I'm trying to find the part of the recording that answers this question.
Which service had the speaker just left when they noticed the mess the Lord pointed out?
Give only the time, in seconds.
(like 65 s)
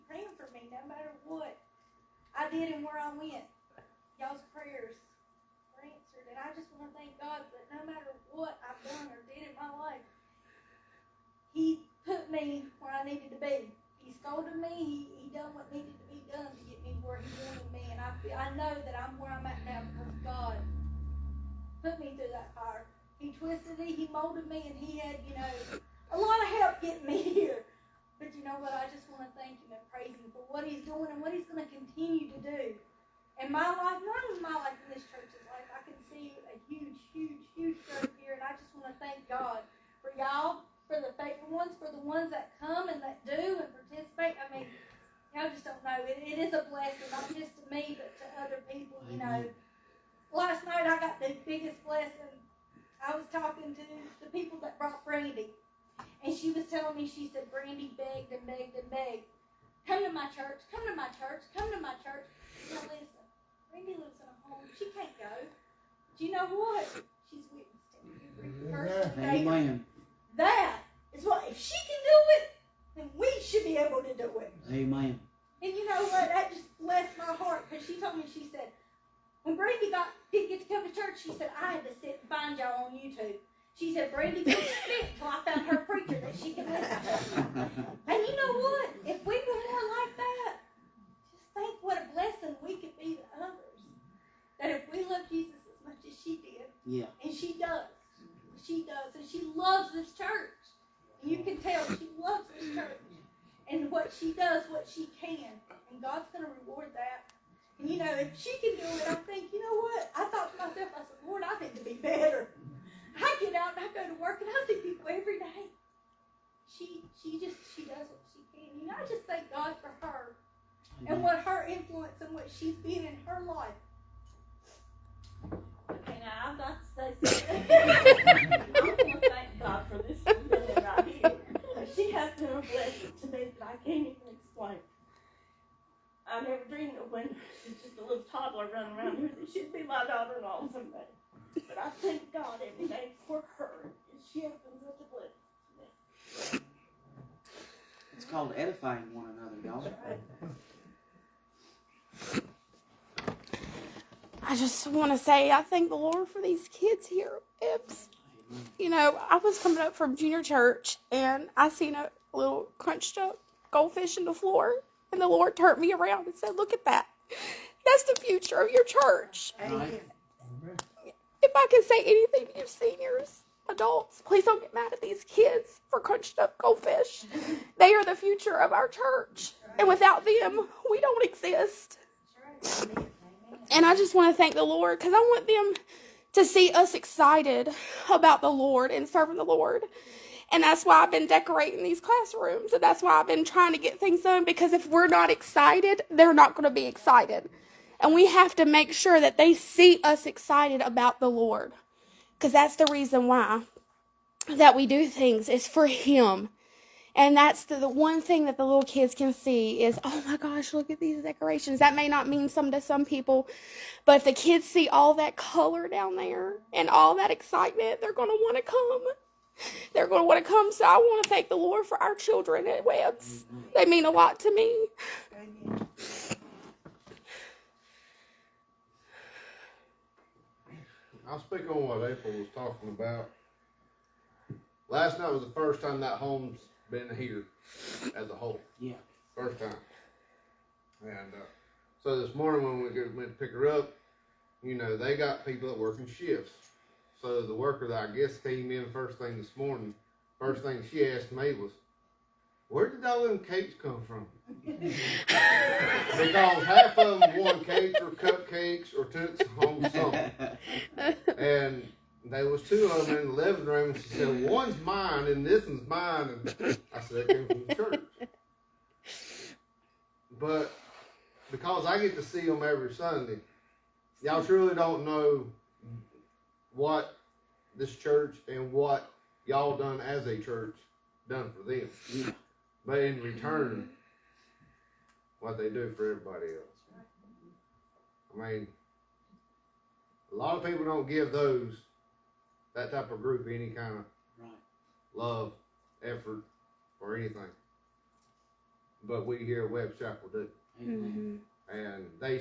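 160 s.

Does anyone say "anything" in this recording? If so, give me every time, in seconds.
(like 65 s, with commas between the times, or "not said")
172 s, 297 s.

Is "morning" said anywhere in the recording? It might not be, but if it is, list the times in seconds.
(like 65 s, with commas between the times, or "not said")
242 s, 249 s.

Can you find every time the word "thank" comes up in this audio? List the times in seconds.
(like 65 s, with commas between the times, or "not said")
6 s, 29 s, 119 s, 141 s, 155 s, 184 s, 221 s.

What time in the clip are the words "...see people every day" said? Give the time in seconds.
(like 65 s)
114 s.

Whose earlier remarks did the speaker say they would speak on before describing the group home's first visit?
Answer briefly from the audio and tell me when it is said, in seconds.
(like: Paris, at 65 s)
April, at 232 s.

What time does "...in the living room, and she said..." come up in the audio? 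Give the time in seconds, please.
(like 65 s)
263 s.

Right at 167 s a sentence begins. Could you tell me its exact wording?
That's the future of your church.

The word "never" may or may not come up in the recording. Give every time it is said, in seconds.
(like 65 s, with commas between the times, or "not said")
136 s.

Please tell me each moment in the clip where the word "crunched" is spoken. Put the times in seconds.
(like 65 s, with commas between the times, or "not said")
162 s, 175 s.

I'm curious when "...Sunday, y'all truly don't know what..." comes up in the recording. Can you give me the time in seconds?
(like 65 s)
272 s.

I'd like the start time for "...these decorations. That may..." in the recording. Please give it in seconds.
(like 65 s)
210 s.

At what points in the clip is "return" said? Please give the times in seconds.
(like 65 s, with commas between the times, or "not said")
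283 s.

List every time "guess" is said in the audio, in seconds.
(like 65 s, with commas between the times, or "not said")
248 s.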